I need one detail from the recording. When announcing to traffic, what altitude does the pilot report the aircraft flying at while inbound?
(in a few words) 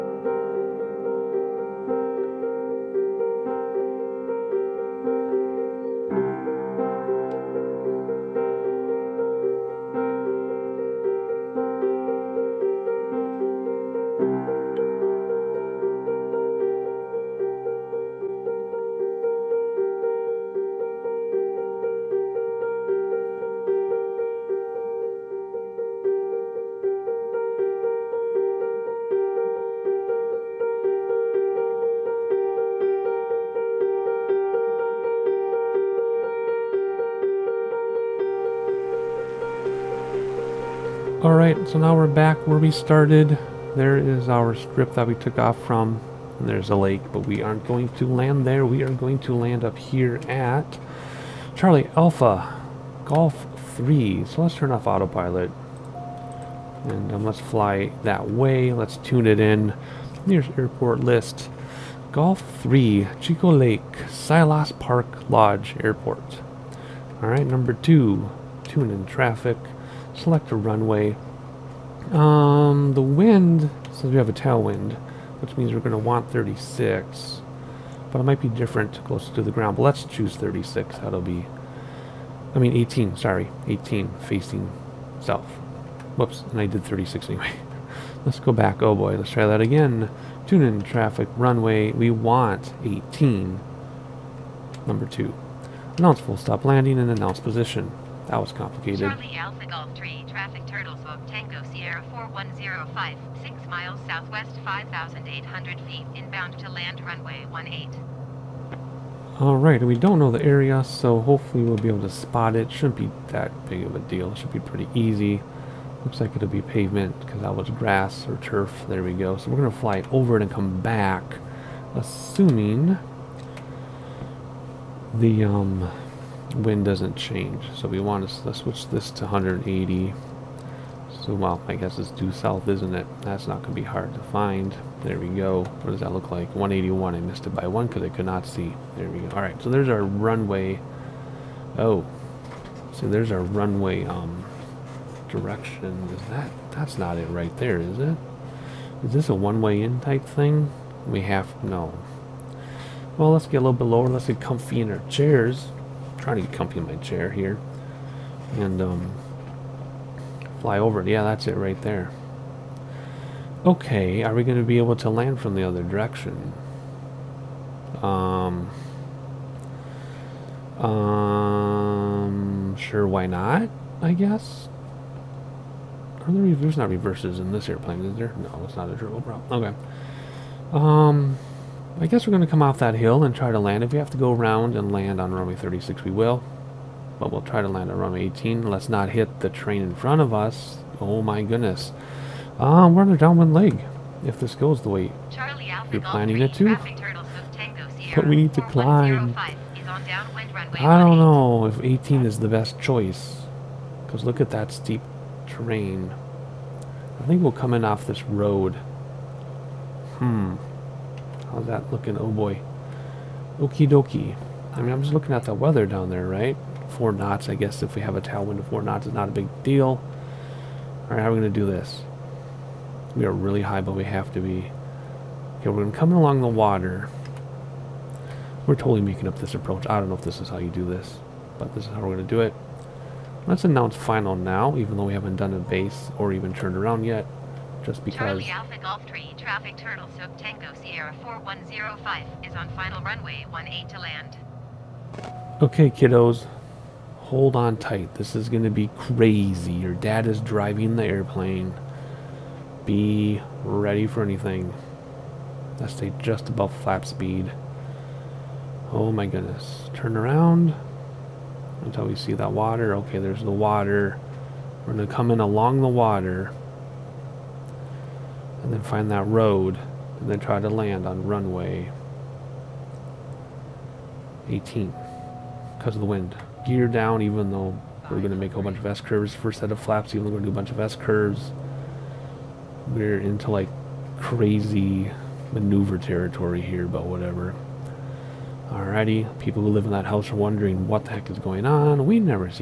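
5,800 feet.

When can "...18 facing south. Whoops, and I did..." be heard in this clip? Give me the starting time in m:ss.
1:23.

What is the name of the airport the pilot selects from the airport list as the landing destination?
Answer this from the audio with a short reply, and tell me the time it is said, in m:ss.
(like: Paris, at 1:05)
Tsylos Park Lodge Airport, at 1:04.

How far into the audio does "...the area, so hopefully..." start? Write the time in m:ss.
1:50.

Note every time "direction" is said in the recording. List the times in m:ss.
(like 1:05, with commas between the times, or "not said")
2:25, 2:45.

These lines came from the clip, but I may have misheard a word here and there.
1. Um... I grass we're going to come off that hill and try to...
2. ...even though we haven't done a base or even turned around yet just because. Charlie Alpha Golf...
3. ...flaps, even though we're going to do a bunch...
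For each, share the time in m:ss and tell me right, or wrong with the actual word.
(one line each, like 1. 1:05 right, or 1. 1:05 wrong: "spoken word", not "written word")
1. 3:00 wrong: "guess", not "grass"
2. 3:54 right
3. 4:39 right.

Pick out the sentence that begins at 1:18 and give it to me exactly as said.
But it might be different closer to the ground.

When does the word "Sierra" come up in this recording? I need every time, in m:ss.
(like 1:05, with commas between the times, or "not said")
1:41, 4:00.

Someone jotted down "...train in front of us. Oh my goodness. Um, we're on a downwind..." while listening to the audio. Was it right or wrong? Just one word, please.
right.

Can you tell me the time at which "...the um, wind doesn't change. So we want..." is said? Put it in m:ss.
2:05.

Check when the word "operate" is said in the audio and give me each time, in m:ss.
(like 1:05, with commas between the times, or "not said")
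not said.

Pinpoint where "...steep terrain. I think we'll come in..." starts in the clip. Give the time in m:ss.
3:24.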